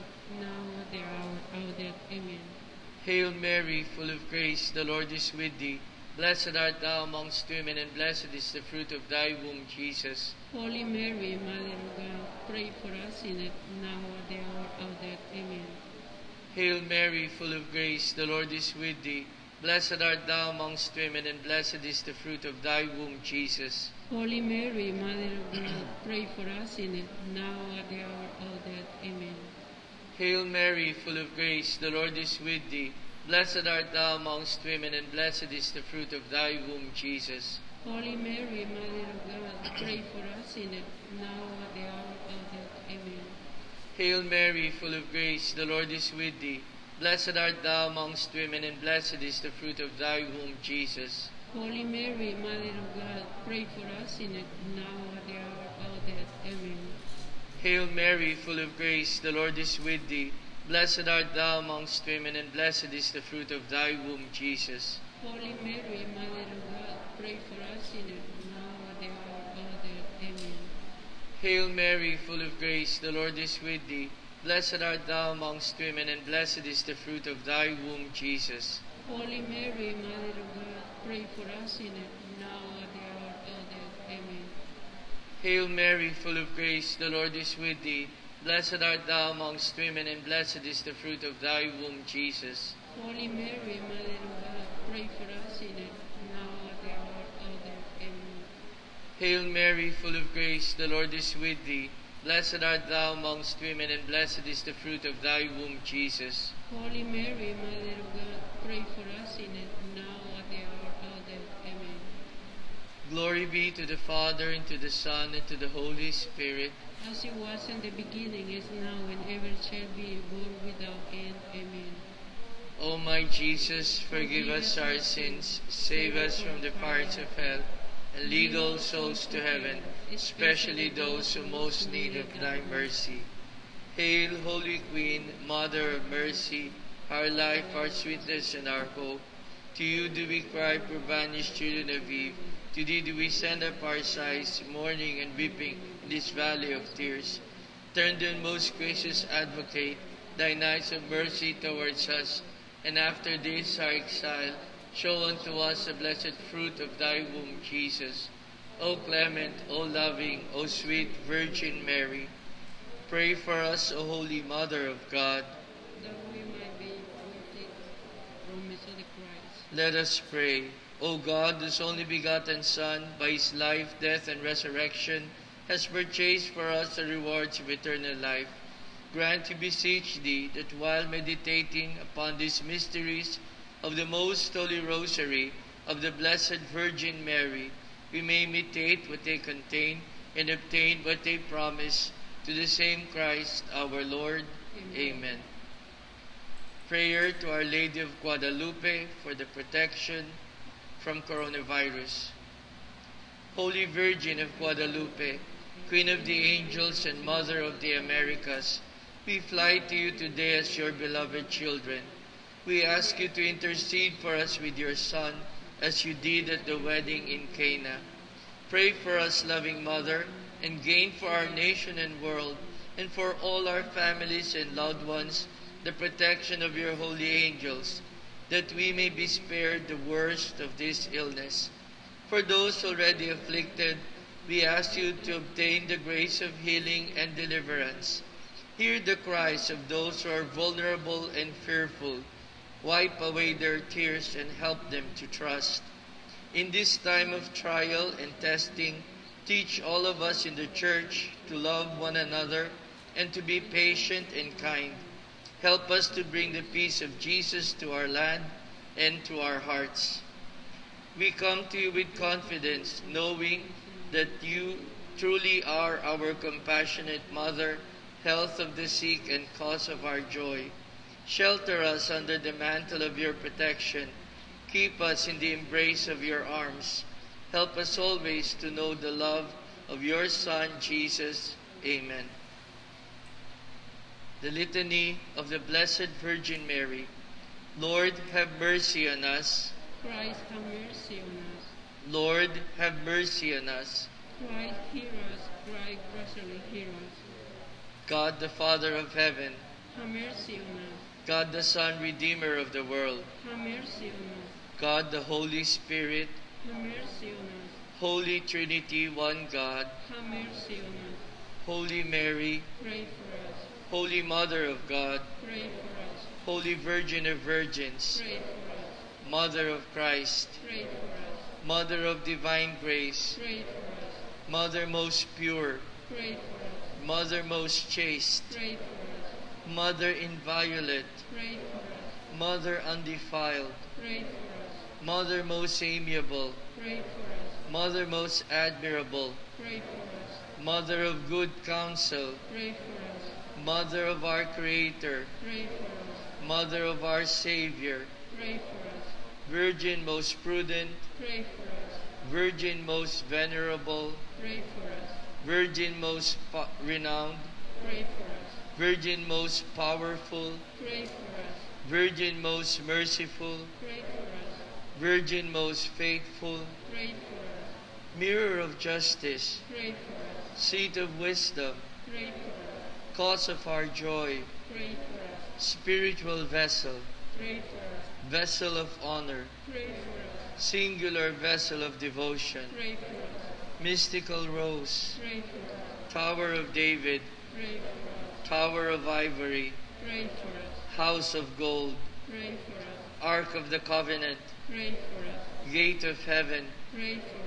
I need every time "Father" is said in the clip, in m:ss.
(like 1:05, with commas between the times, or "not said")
1:53, 4:58.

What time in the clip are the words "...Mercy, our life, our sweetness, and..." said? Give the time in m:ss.
2:16.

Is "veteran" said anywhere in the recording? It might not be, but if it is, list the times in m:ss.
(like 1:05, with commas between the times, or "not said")
not said.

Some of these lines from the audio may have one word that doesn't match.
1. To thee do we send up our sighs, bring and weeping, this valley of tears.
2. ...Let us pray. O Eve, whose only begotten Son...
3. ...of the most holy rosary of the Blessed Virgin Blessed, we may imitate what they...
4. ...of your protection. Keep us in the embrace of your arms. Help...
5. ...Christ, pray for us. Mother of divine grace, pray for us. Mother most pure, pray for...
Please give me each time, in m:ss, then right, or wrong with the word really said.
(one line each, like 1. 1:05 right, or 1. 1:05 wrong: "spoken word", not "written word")
1. 2:22 wrong: "mourning", not "bring"
2. 2:49 wrong: "God", not "Eve"
3. 3:03 wrong: "Mary", not "Blessed"
4. 4:33 right
5. 5:19 right.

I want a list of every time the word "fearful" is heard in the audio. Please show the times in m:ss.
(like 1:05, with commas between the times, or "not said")
4:01.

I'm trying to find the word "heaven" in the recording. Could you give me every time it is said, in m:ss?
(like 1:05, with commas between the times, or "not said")
2:09, 4:59, 6:36.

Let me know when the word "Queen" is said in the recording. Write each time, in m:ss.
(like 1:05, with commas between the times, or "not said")
2:14, 3:25.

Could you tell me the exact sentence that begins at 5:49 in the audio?
Virgin most prudent, pray for us.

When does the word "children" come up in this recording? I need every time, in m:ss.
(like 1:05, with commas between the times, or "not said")
2:21, 3:31.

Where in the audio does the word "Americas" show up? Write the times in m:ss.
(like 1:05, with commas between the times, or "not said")
3:27.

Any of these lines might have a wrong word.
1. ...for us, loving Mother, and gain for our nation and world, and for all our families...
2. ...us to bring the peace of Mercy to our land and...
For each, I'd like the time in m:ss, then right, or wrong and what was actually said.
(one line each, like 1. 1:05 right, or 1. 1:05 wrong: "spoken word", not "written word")
1. 3:38 right
2. 4:15 wrong: "Jesus", not "Mercy".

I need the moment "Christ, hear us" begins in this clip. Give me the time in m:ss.
4:54.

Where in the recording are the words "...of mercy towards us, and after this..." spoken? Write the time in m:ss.
2:30.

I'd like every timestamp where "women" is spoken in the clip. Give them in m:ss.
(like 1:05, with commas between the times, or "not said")
0:07, 0:20, 0:34, 0:48, 1:02, 1:15, 1:29, 1:43.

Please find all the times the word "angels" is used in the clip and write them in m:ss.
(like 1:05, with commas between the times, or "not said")
3:26, 3:47.